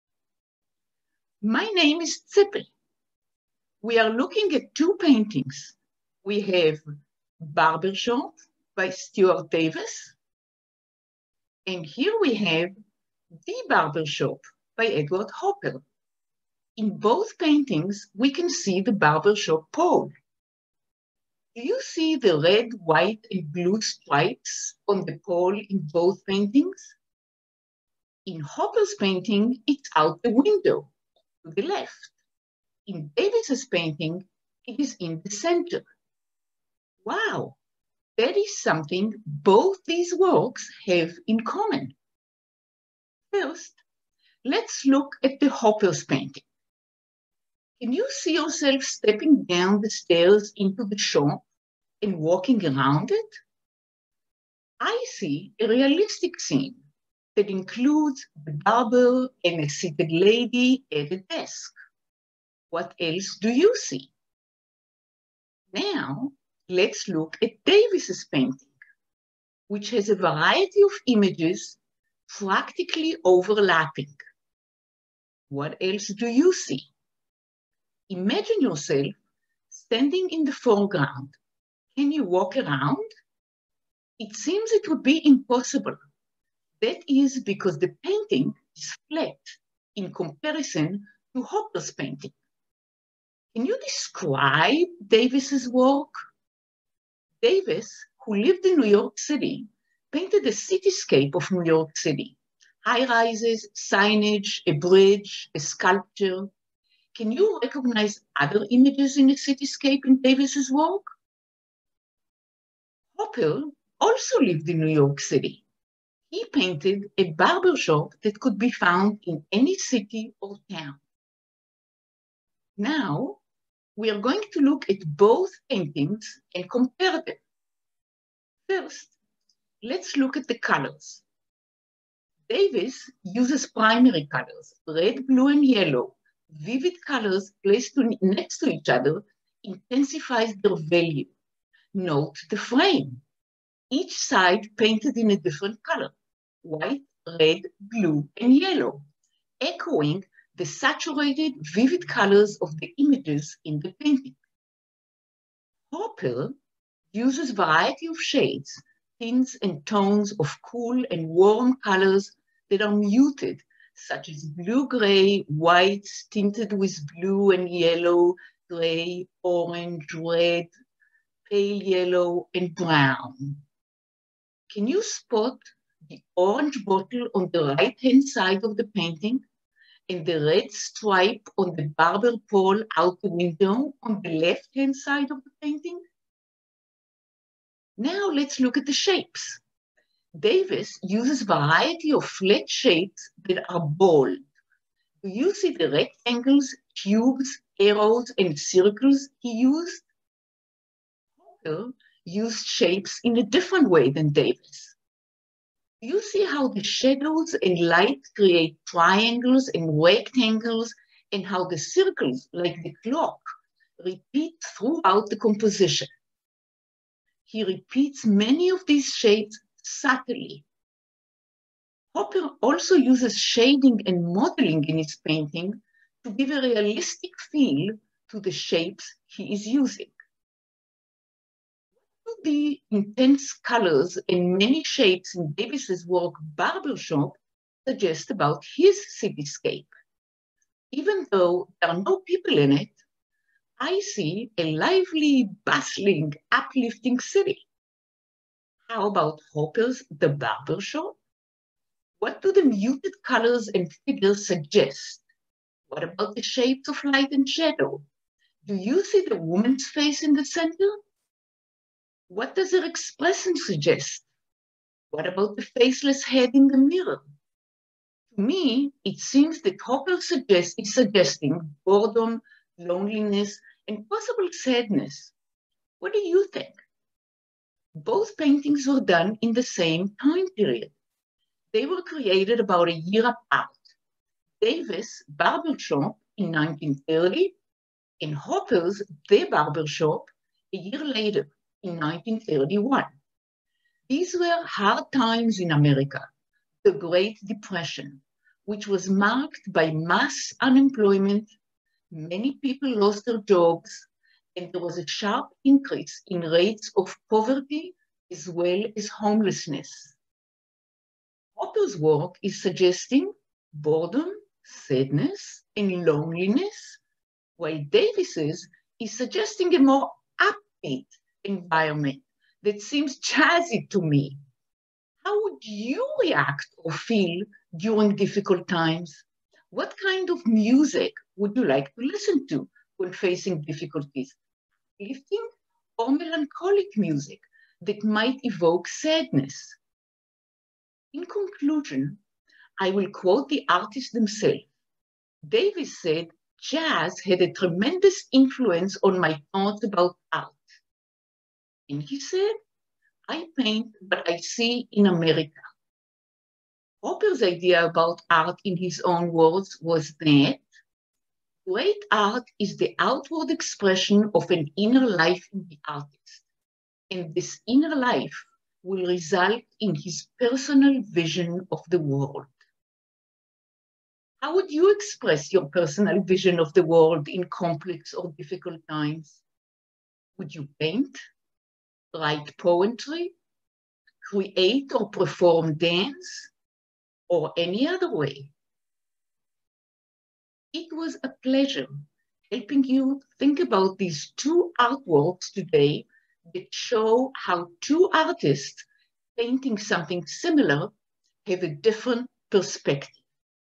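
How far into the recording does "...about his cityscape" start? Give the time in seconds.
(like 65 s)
238 s.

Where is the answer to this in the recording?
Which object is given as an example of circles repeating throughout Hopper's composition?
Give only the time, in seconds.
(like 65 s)
212 s.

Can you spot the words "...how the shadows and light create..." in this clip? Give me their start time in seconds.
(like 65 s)
206 s.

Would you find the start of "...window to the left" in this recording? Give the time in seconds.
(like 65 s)
30 s.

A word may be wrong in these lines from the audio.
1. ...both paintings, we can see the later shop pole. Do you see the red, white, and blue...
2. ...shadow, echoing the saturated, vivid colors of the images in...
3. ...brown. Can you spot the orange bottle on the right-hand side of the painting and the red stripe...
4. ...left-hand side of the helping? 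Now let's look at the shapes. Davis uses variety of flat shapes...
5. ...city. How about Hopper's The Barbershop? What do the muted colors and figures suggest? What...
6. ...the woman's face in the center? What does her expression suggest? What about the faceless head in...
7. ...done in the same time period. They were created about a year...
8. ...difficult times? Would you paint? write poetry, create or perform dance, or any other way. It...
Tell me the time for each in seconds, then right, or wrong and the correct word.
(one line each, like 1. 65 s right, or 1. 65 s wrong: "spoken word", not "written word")
1. 16 s wrong: "barber", not "later"
2. 148 s wrong: "yellow", not "shadow"
3. 172 s right
4. 184 s wrong: "painting", not "helping"
5. 247 s right
6. 259 s right
7. 279 s right
8. 378 s right.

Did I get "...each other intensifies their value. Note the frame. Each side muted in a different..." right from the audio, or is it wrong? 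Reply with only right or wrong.
wrong.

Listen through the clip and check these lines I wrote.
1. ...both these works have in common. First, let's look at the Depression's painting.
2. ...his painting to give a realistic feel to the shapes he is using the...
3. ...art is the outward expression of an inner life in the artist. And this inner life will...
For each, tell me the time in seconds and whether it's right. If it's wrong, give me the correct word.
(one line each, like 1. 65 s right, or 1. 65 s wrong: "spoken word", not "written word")
1. 39 s wrong: "Hopper", not "Depression"
2. 224 s right
3. 362 s right.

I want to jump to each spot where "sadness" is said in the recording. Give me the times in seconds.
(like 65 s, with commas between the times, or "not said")
274 s, 314 s, 338 s.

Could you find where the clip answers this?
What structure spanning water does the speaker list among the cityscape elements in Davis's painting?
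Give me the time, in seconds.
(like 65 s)
104 s.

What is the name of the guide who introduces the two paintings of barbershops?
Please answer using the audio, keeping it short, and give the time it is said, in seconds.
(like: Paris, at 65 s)
Zippel, at 2 s.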